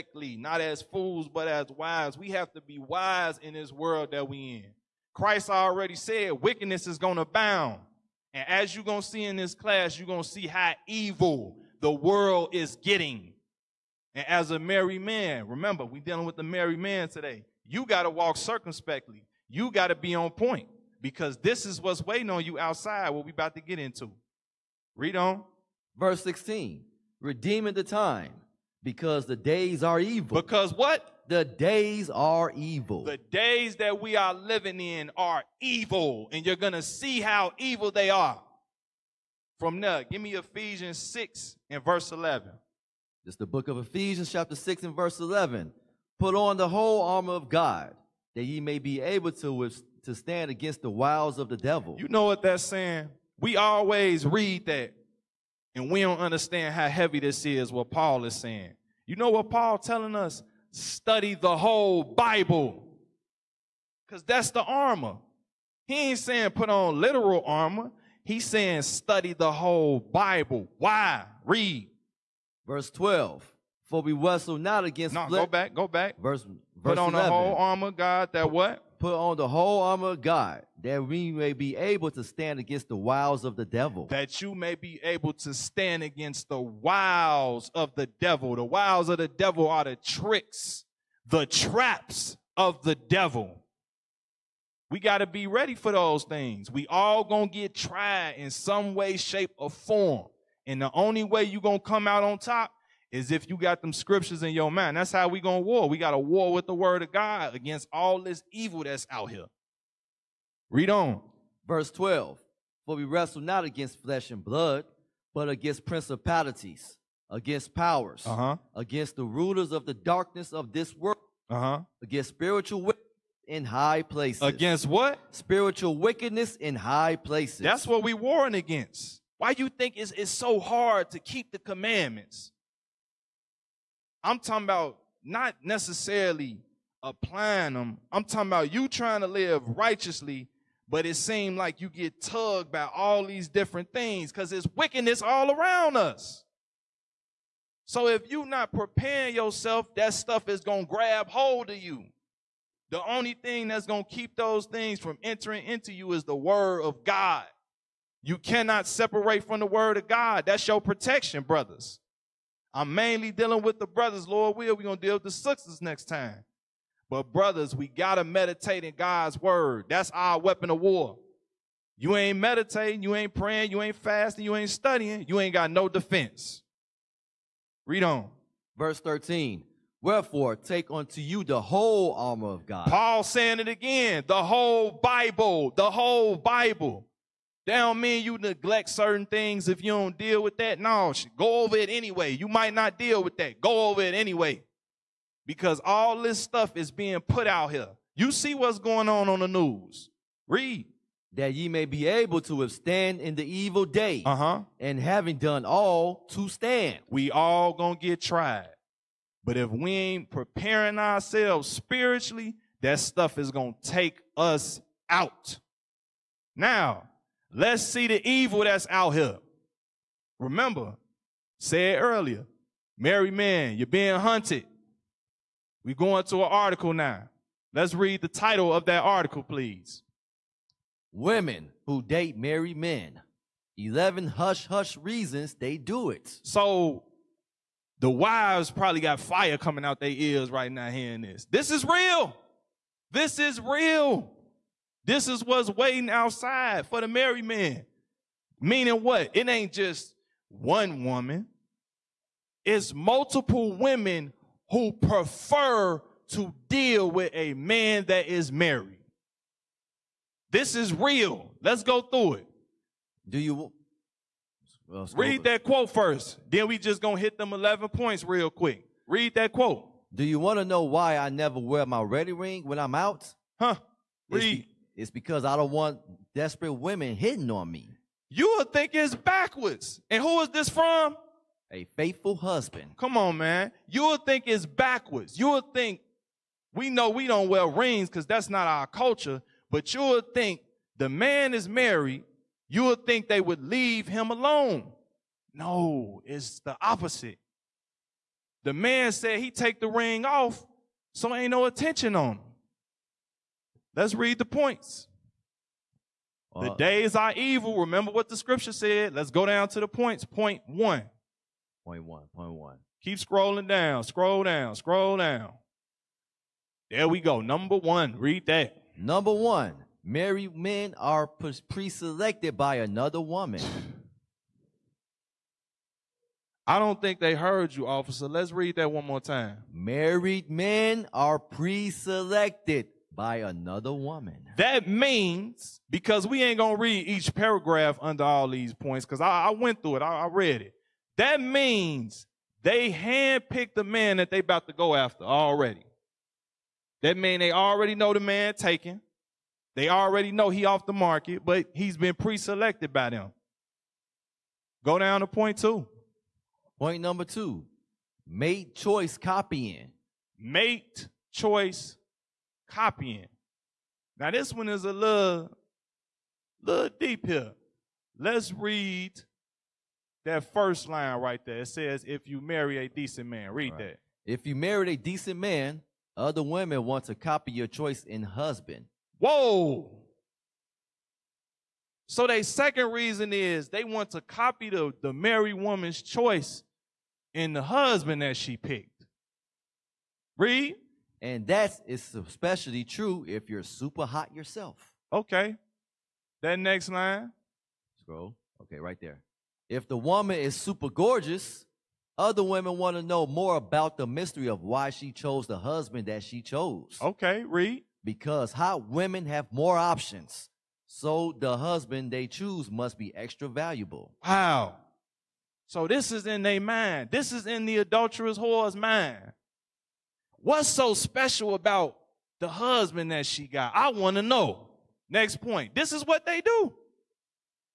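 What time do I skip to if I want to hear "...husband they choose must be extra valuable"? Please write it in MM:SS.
06:51.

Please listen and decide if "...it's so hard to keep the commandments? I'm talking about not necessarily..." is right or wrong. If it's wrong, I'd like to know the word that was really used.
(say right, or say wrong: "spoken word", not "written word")
right.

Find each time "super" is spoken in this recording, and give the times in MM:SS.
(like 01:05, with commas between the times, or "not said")
06:33, 06:40.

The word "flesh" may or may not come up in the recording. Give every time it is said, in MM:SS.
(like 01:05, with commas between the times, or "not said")
01:15, 01:54.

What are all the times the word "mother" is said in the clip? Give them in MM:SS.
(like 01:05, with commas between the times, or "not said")
not said.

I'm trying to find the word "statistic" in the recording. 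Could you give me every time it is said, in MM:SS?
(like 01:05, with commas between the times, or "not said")
not said.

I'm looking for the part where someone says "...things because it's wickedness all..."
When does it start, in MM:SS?
02:23.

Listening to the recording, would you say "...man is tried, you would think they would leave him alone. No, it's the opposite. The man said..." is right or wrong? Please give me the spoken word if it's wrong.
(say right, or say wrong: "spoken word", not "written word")
wrong: "married", not "tried".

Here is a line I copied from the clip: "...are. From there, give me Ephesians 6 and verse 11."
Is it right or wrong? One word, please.
right.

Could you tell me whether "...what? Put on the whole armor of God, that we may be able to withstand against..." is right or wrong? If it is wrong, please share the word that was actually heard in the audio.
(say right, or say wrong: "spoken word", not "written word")
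wrong: "stand", not "withstand".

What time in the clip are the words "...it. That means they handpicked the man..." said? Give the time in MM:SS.
05:40.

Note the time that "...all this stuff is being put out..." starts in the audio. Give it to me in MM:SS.
03:15.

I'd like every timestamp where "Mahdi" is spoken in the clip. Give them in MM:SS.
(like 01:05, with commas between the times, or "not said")
not said.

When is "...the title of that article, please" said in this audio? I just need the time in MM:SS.
03:48.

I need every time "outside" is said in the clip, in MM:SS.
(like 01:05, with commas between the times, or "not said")
00:22, 04:06.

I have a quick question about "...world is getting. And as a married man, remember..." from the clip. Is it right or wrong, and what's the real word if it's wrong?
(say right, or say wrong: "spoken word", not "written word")
right.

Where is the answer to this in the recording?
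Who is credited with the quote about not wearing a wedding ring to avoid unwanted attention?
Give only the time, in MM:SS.
04:41.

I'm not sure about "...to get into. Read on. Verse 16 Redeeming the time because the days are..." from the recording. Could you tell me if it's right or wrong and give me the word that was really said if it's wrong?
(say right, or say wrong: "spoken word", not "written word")
right.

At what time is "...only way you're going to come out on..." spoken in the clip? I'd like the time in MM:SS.
01:40.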